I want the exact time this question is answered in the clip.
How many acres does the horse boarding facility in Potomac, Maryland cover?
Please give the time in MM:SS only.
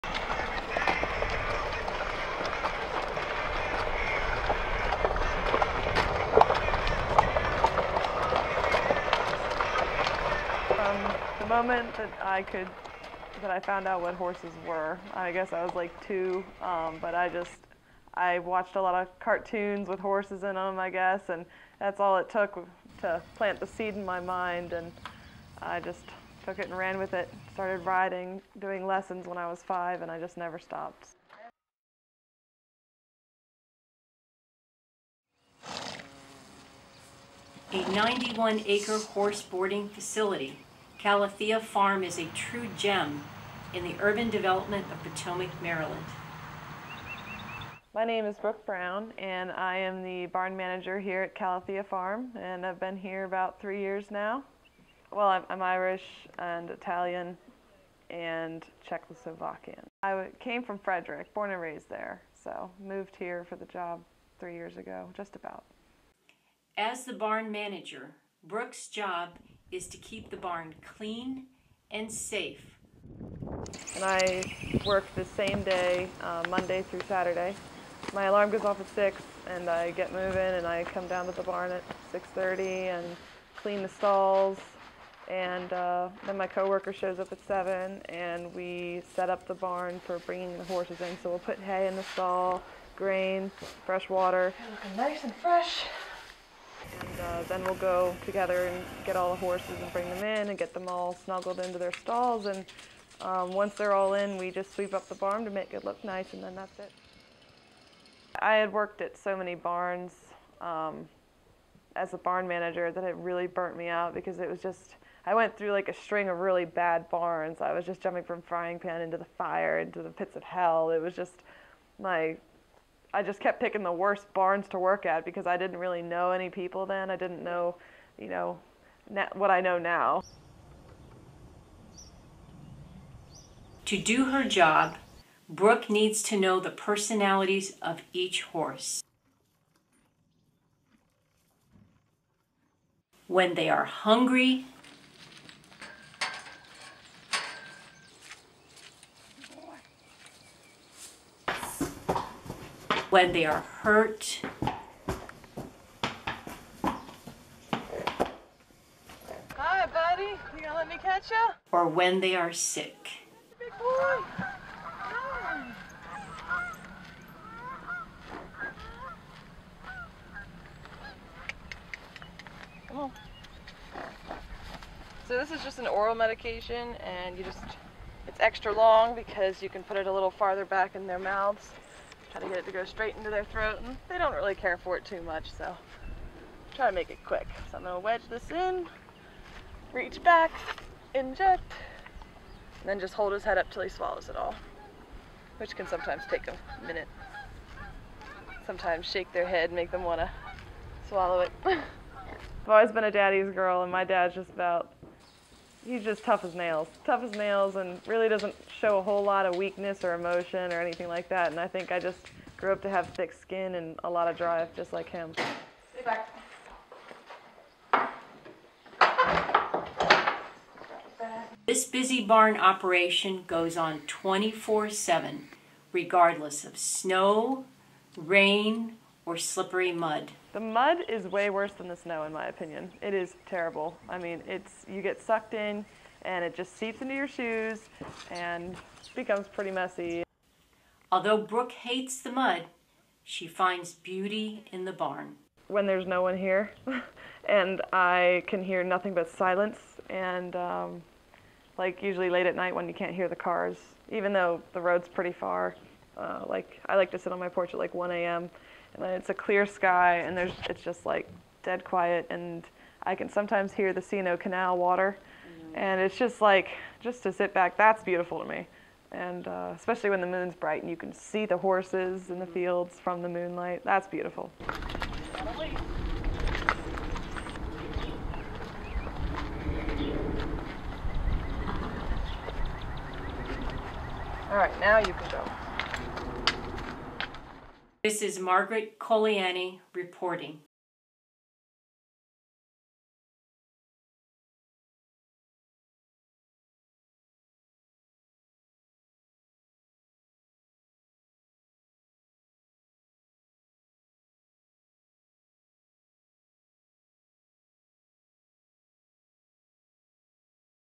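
00:37.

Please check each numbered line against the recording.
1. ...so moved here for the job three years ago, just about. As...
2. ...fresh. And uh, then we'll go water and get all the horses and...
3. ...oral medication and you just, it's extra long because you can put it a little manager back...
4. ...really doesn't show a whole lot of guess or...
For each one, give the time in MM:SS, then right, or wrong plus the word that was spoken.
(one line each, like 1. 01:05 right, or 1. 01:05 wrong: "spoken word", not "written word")
1. 01:02 right
2. 01:35 wrong: "together", not "water"
3. 02:55 wrong: "farther", not "manager"
4. 03:28 wrong: "weakness", not "guess".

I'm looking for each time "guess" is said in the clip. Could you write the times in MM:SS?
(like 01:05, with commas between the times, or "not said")
00:15, 00:20.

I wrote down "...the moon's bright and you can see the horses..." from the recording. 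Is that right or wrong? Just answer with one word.
right.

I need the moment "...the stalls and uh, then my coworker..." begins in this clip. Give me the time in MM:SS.
01:23.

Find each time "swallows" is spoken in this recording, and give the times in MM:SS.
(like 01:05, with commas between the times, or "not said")
03:13, 03:21.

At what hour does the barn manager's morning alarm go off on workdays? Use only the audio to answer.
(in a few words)
6.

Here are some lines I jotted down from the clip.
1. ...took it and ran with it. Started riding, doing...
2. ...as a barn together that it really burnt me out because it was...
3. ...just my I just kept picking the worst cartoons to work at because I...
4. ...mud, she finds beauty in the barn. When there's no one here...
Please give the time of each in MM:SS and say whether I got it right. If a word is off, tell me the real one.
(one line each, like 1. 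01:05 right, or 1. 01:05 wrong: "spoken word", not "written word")
1. 00:26 right
2. 01:51 wrong: "manager", not "together"
3. 02:01 wrong: "barns", not "cartoons"
4. 04:02 right.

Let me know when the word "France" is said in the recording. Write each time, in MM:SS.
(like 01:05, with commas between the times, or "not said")
not said.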